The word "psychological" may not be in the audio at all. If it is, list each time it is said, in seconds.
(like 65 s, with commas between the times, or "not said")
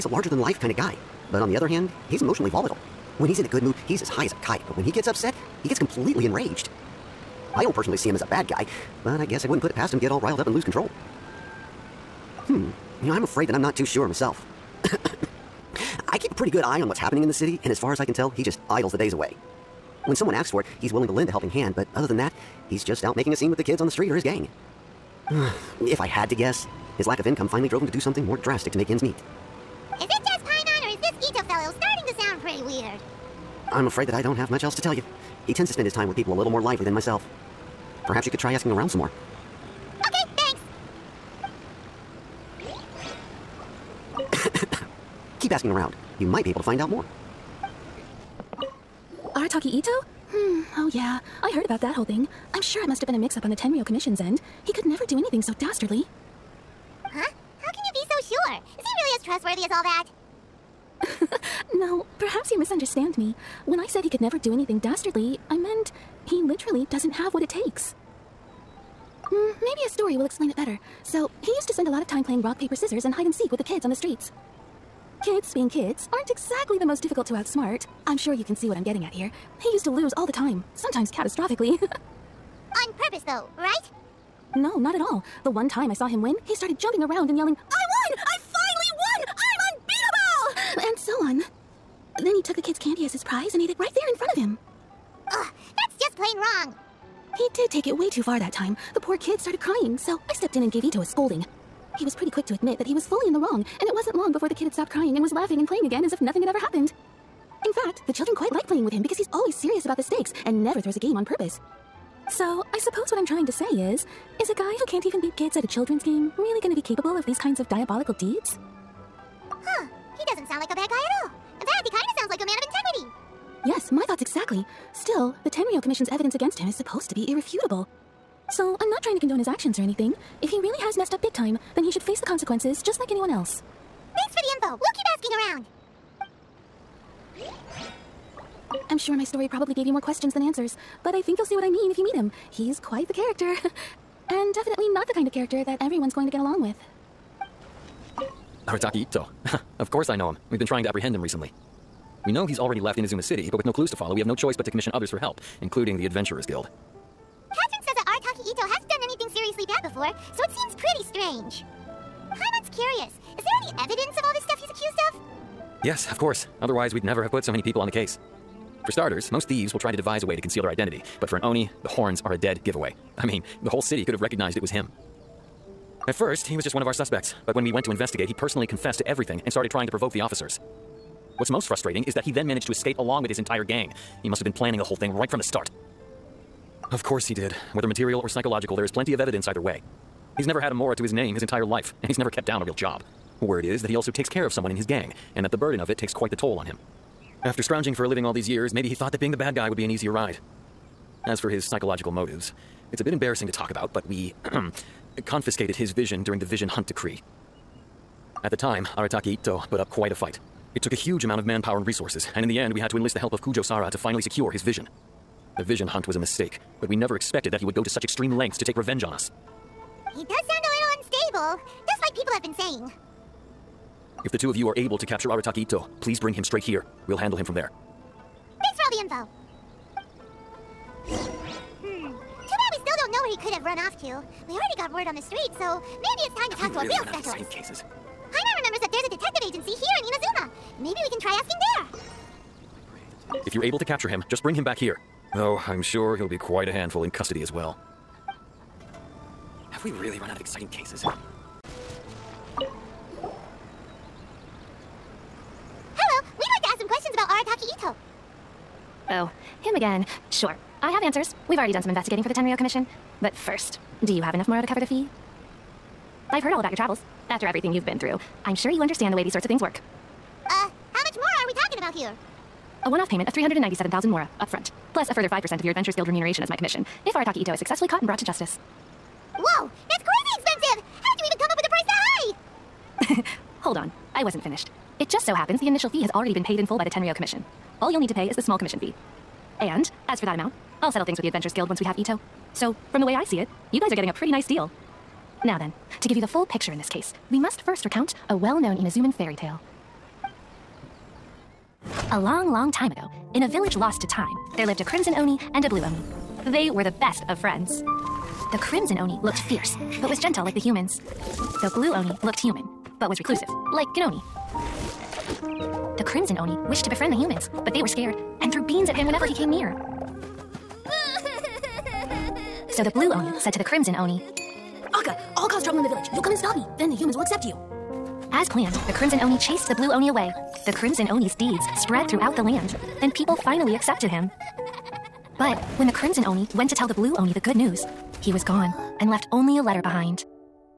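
188 s, 201 s.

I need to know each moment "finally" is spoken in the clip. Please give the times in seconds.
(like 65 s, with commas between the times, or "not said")
27 s, 88 s, 213 s, 333 s.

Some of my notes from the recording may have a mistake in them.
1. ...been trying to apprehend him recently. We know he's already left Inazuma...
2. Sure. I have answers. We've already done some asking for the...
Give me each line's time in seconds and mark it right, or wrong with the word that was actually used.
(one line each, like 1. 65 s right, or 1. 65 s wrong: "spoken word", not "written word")
1. 150 s right
2. 260 s wrong: "investigating", not "asking".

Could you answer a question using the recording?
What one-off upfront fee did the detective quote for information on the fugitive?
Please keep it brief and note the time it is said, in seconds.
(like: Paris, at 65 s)
397,000 Mora, at 273 s.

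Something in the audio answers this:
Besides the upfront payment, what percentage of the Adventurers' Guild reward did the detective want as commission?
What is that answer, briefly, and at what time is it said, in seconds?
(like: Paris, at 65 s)
5%, at 275 s.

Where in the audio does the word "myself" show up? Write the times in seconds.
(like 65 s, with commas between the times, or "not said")
14 s, 36 s.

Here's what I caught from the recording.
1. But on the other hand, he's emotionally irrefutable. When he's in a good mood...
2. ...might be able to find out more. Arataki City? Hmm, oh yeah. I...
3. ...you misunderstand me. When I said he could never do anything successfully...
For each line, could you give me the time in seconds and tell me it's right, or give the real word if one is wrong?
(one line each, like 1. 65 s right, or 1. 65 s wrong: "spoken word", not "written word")
1. 1 s wrong: "volatile", not "irrefutable"
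2. 46 s wrong: "Itto", not "City"
3. 62 s wrong: "dastardly", not "successfully".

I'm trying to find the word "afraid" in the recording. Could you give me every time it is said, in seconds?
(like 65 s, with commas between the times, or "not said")
13 s, 33 s.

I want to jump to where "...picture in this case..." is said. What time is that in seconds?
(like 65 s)
296 s.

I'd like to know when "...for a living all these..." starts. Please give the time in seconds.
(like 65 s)
197 s.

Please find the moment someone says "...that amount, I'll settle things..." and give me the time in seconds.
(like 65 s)
290 s.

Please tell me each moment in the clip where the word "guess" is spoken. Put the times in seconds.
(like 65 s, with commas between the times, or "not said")
9 s, 26 s.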